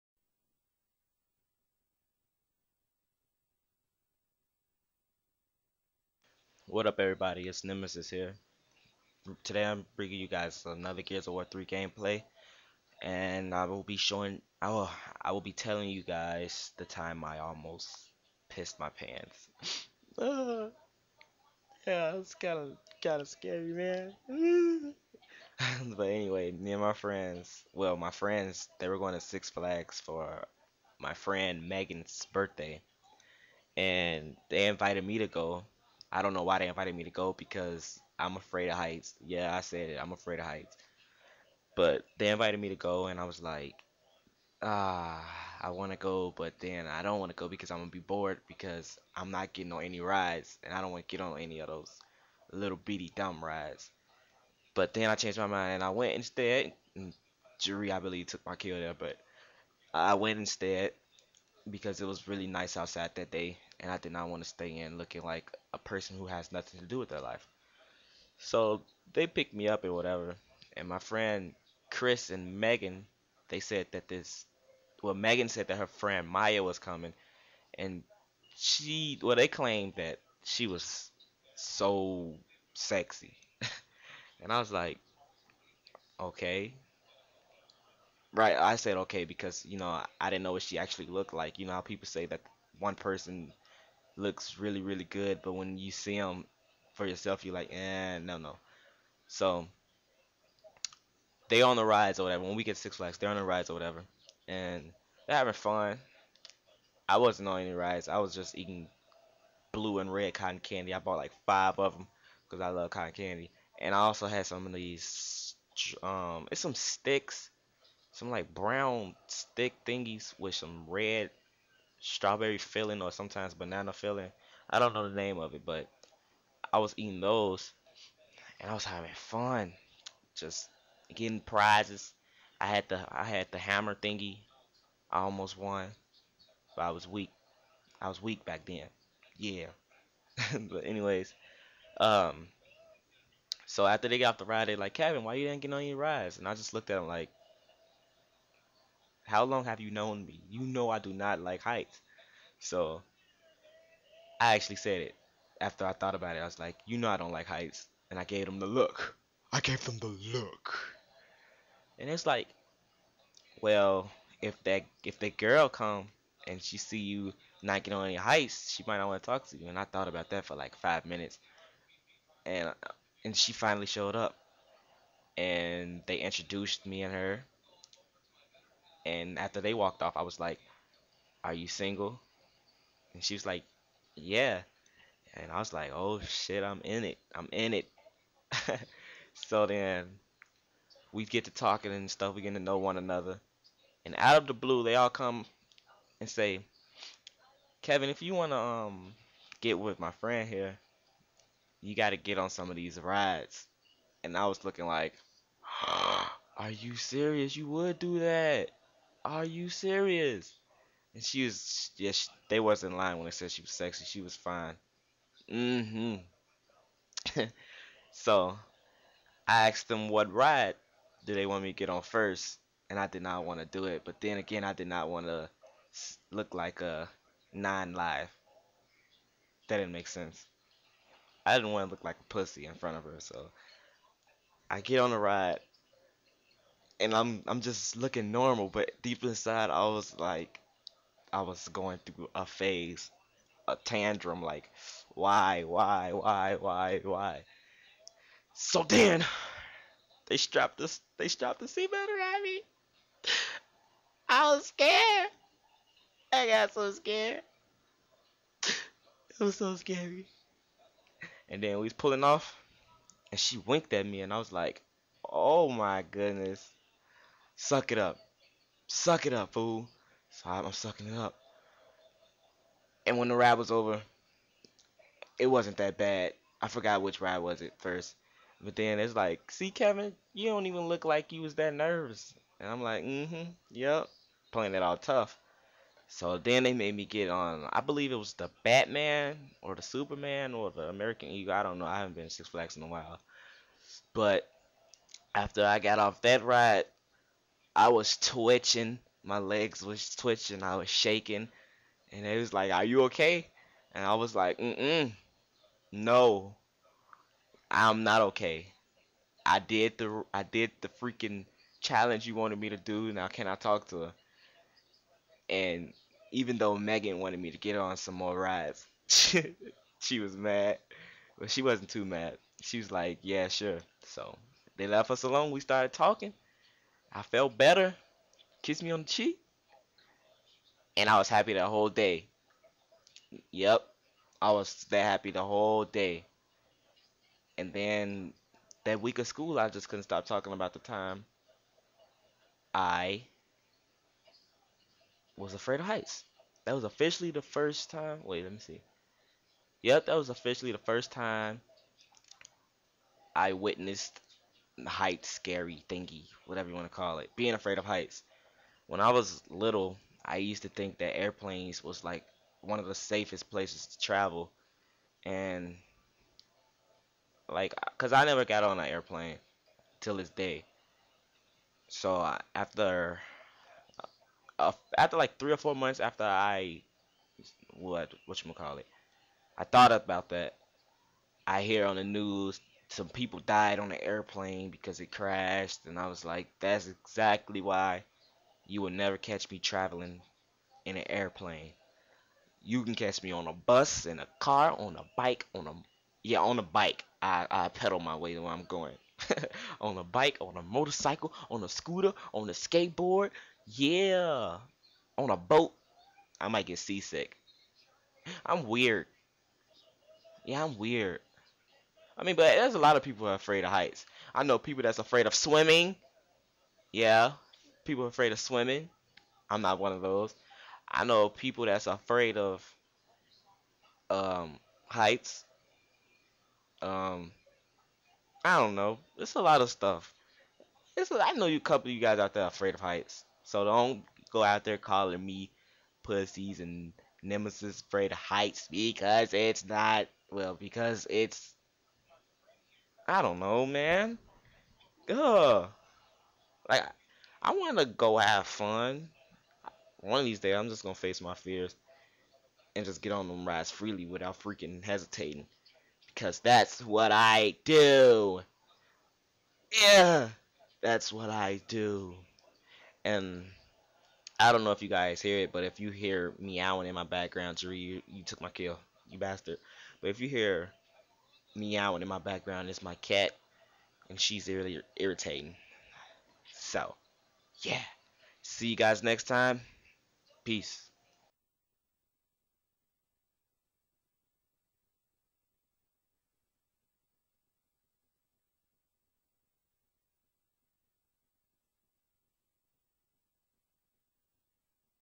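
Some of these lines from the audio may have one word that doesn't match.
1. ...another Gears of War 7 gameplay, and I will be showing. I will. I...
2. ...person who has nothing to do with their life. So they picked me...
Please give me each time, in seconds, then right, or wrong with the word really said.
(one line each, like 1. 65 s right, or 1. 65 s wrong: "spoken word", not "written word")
1. 10 s wrong: "3", not "7"
2. 65 s right.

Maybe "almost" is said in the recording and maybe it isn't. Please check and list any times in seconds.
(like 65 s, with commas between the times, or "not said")
17 s, 135 s.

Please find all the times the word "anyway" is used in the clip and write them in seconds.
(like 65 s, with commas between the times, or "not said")
26 s, 140 s.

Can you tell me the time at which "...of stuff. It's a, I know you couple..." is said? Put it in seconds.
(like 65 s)
429 s.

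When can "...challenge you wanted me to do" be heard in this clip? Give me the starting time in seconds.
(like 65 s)
311 s.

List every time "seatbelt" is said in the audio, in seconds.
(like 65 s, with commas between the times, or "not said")
251 s.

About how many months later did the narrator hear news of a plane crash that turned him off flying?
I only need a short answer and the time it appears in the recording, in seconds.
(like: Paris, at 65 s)
3 or 4 months, at 375 s.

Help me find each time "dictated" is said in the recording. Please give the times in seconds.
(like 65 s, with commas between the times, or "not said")
not said.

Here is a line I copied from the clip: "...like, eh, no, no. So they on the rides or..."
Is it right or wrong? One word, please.
right.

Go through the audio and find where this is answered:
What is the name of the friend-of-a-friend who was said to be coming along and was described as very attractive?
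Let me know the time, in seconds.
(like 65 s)
76 s.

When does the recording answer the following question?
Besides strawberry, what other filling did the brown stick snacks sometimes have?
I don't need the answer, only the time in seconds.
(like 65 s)
123 s.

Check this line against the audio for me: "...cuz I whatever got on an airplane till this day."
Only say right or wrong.
wrong.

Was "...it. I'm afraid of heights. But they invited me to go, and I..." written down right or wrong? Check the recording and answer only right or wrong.
right.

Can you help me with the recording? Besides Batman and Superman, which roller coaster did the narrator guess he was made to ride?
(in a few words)
American Eagle.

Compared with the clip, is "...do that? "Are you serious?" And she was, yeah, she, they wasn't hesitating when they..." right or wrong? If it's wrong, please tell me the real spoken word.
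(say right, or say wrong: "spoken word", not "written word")
wrong: "lying", not "hesitating".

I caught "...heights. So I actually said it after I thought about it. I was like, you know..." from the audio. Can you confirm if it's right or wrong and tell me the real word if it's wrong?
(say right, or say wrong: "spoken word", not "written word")
right.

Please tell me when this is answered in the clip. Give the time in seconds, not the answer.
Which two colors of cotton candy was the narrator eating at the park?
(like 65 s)
109 s.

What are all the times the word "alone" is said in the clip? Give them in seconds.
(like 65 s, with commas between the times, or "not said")
325 s.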